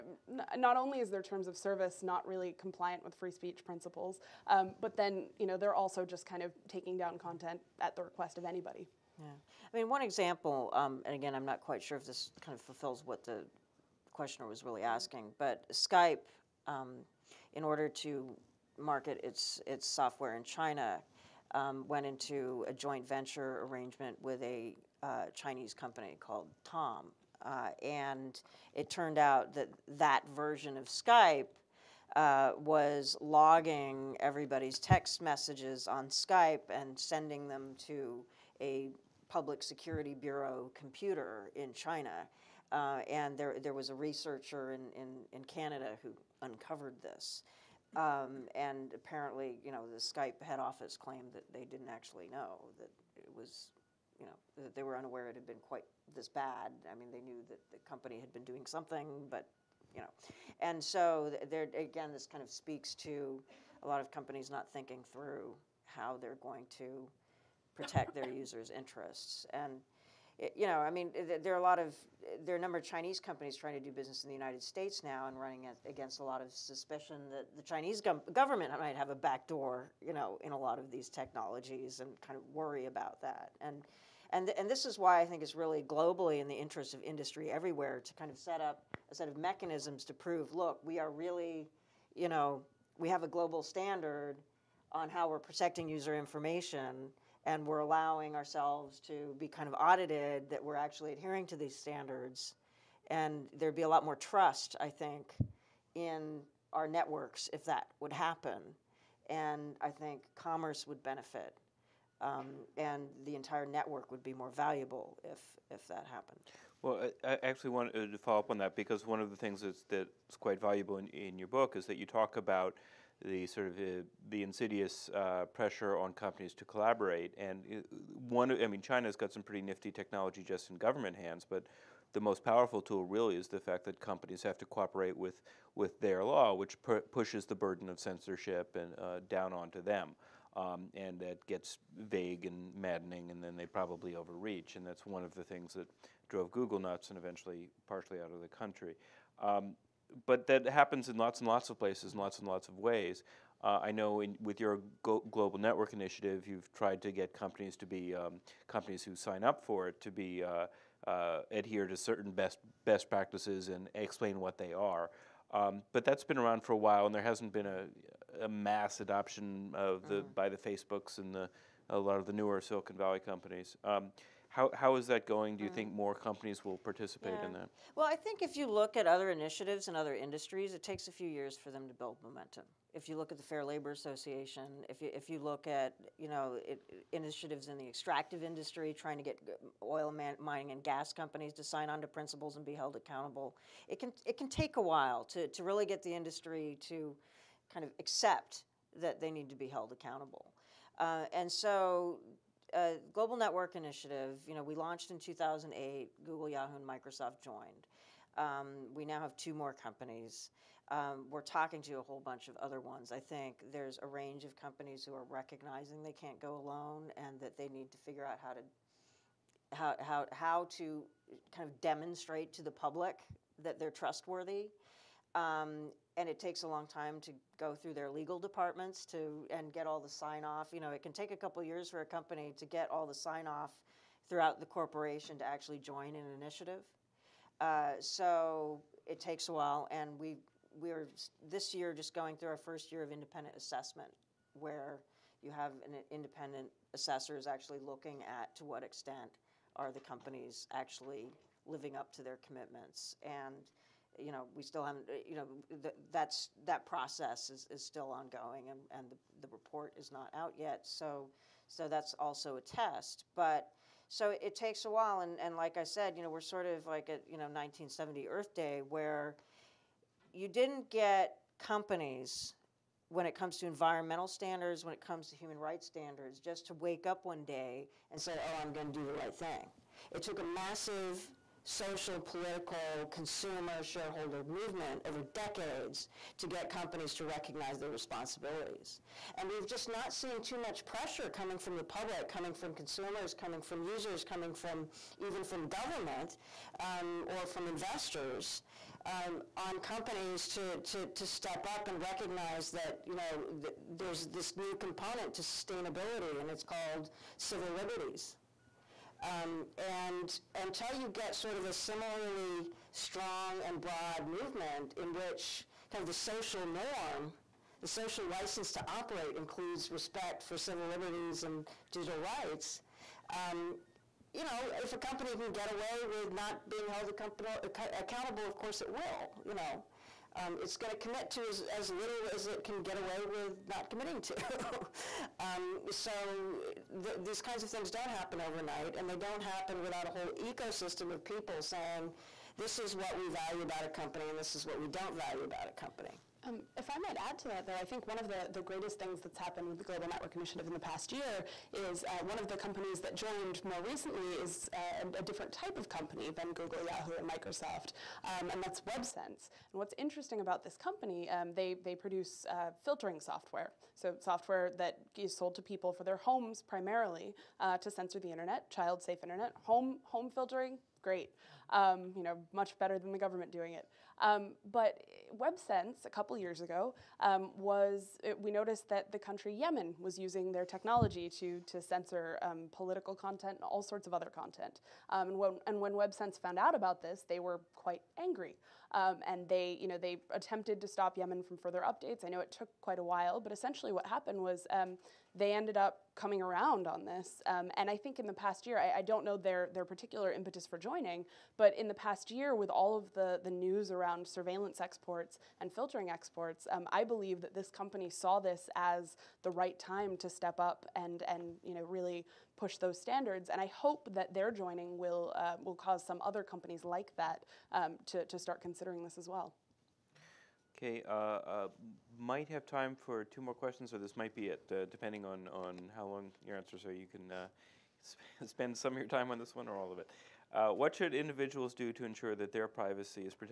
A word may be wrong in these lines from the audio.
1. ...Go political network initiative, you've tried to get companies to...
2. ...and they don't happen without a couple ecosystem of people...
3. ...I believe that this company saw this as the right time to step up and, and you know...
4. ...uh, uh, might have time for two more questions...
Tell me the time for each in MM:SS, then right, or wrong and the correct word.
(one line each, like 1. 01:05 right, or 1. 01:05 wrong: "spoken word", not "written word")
1. 02:35 wrong: "global", not "political"
2. 05:38 wrong: "whole", not "couple"
3. 06:46 right
4. 07:01 right.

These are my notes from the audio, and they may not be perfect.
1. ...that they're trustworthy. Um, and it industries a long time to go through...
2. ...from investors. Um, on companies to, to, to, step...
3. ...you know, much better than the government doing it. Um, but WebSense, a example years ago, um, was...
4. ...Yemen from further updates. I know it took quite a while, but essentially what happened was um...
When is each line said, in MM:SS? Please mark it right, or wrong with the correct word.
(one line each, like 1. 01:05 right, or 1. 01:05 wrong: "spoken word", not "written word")
1. 03:43 wrong: "takes", not "industries"
2. 04:57 right
3. 06:12 wrong: "couple", not "example"
4. 06:31 right.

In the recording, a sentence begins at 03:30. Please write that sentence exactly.
Um, we're talking to a whole bunch of other ones.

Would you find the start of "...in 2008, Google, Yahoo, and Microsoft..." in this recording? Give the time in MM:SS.
03:25.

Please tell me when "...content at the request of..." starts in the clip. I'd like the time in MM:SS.
00:07.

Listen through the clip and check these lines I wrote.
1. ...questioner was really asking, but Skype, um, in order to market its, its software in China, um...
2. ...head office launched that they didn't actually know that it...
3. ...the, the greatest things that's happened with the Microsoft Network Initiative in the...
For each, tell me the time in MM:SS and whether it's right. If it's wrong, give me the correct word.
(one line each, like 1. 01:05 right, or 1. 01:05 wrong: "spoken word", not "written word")
1. 00:14 right
2. 00:50 wrong: "claimed", not "launched"
3. 05:48 wrong: "Global", not "Microsoft".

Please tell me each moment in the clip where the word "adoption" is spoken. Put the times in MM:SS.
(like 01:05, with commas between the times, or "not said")
02:49.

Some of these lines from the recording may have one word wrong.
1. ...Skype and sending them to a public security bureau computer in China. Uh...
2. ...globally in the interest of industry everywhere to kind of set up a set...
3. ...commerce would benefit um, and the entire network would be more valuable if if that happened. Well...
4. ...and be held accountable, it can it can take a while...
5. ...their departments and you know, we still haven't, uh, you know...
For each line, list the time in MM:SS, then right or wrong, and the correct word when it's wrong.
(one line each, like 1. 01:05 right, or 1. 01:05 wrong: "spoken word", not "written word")
1. 00:36 right
2. 01:25 right
3. 01:50 right
4. 03:12 right
5. 04:12 wrong: "commitments", not "departments".